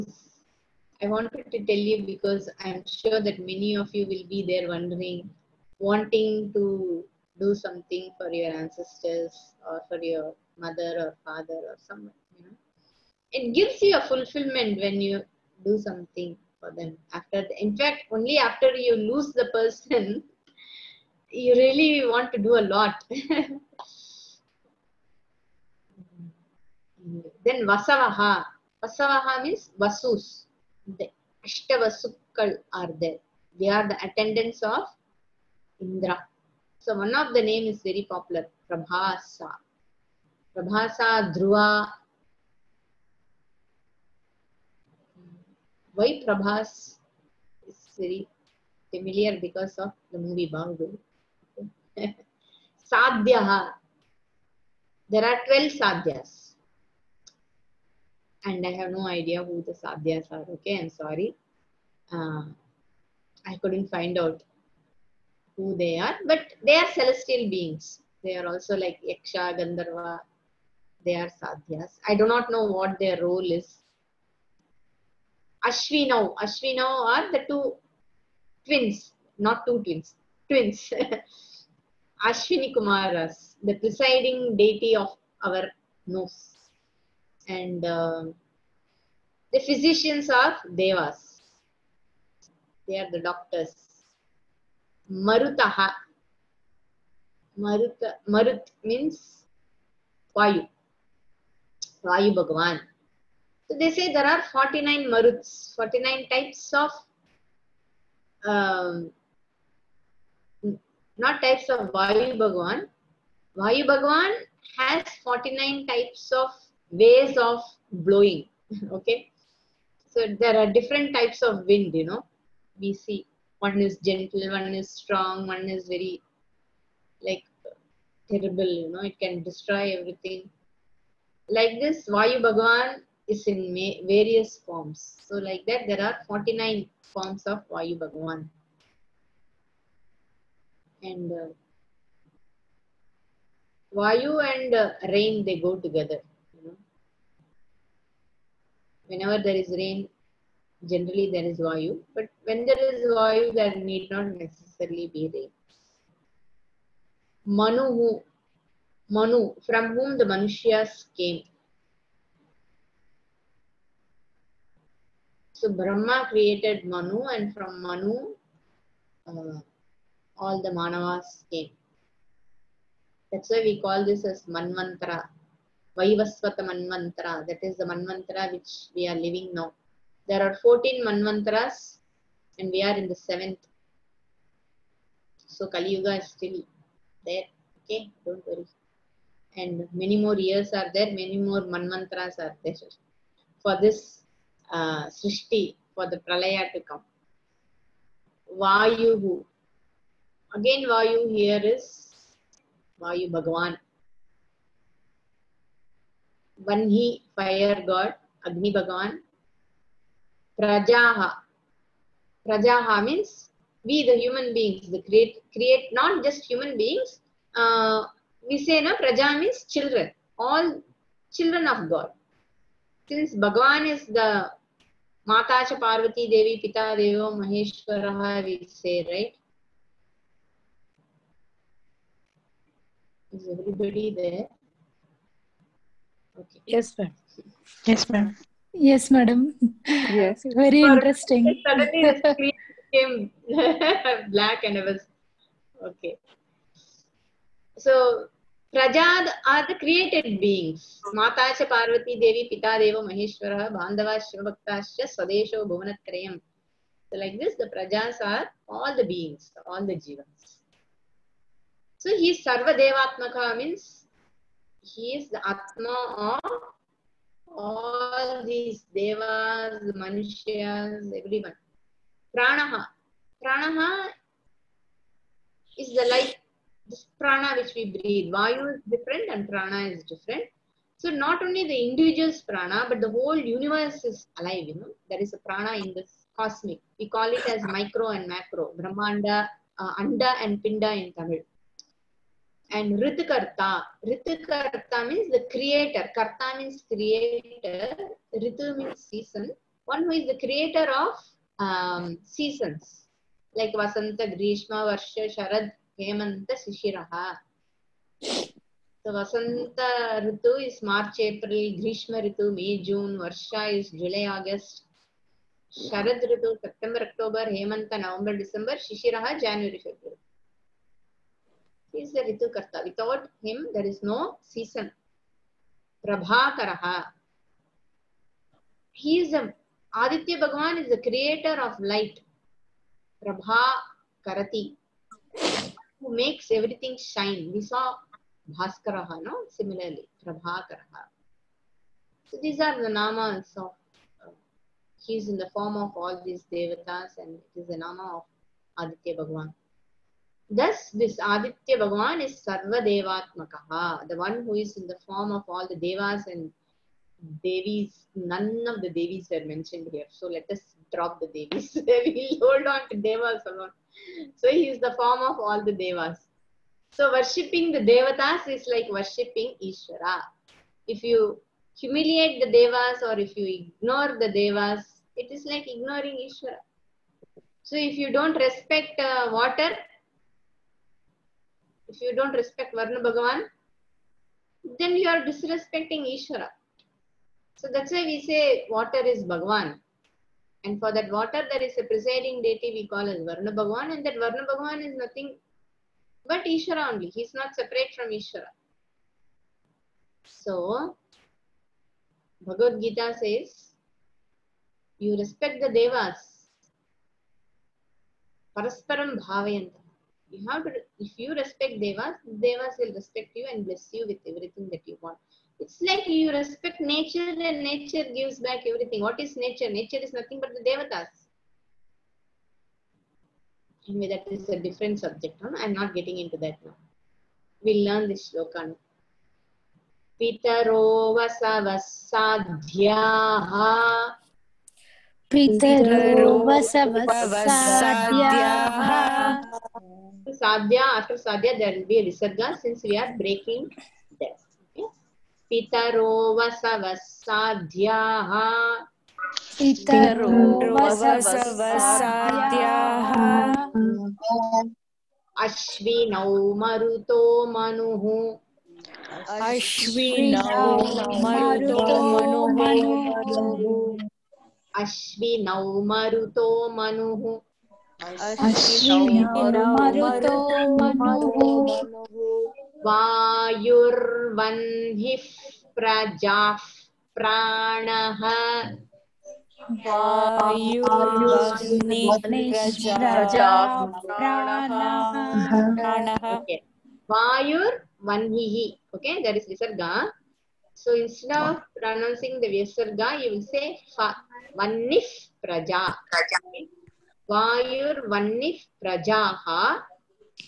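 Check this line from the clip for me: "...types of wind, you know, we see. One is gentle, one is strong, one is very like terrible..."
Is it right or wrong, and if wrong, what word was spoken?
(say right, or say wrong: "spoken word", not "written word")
right.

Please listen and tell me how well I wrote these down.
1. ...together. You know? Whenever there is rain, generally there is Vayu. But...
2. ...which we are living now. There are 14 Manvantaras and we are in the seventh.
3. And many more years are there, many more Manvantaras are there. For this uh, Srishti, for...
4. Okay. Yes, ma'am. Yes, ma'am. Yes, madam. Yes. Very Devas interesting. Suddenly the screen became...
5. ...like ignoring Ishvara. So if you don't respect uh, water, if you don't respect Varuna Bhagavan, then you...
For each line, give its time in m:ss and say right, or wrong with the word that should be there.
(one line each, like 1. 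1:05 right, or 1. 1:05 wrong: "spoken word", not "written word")
1. 2:25 right
2. 2:58 right
3. 3:09 right
4. 3:56 wrong: "For", not "Devas"
5. 6:15 right.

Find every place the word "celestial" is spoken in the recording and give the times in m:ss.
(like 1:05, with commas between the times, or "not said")
1:06.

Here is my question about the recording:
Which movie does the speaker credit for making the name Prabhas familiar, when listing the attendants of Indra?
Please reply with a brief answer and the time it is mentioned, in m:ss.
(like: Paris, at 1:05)
Bangu, at 0:50.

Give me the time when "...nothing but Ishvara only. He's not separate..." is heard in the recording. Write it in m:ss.
6:34.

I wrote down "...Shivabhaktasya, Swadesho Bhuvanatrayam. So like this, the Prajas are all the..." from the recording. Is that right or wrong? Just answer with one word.
right.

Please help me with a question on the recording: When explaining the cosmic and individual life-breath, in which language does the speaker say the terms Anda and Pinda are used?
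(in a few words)
Tamil.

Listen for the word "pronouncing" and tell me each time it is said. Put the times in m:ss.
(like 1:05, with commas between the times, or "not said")
8:11.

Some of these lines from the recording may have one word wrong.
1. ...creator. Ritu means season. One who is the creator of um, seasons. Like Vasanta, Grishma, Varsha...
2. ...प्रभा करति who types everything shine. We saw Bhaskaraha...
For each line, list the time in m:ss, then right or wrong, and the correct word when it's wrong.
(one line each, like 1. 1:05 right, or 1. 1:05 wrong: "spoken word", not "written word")
1. 4:56 right
2. 5:33 wrong: "makes", not "types".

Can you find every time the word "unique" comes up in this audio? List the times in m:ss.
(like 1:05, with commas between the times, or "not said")
not said.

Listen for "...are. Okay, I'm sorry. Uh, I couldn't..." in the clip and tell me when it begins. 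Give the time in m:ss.
1:00.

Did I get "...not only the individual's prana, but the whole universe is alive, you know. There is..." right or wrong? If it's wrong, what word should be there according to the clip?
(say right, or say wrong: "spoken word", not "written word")
right.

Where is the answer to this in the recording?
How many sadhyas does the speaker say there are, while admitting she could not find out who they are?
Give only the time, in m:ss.
0:55.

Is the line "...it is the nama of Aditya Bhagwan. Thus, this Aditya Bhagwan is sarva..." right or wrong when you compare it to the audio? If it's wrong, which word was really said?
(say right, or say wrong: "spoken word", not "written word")
right.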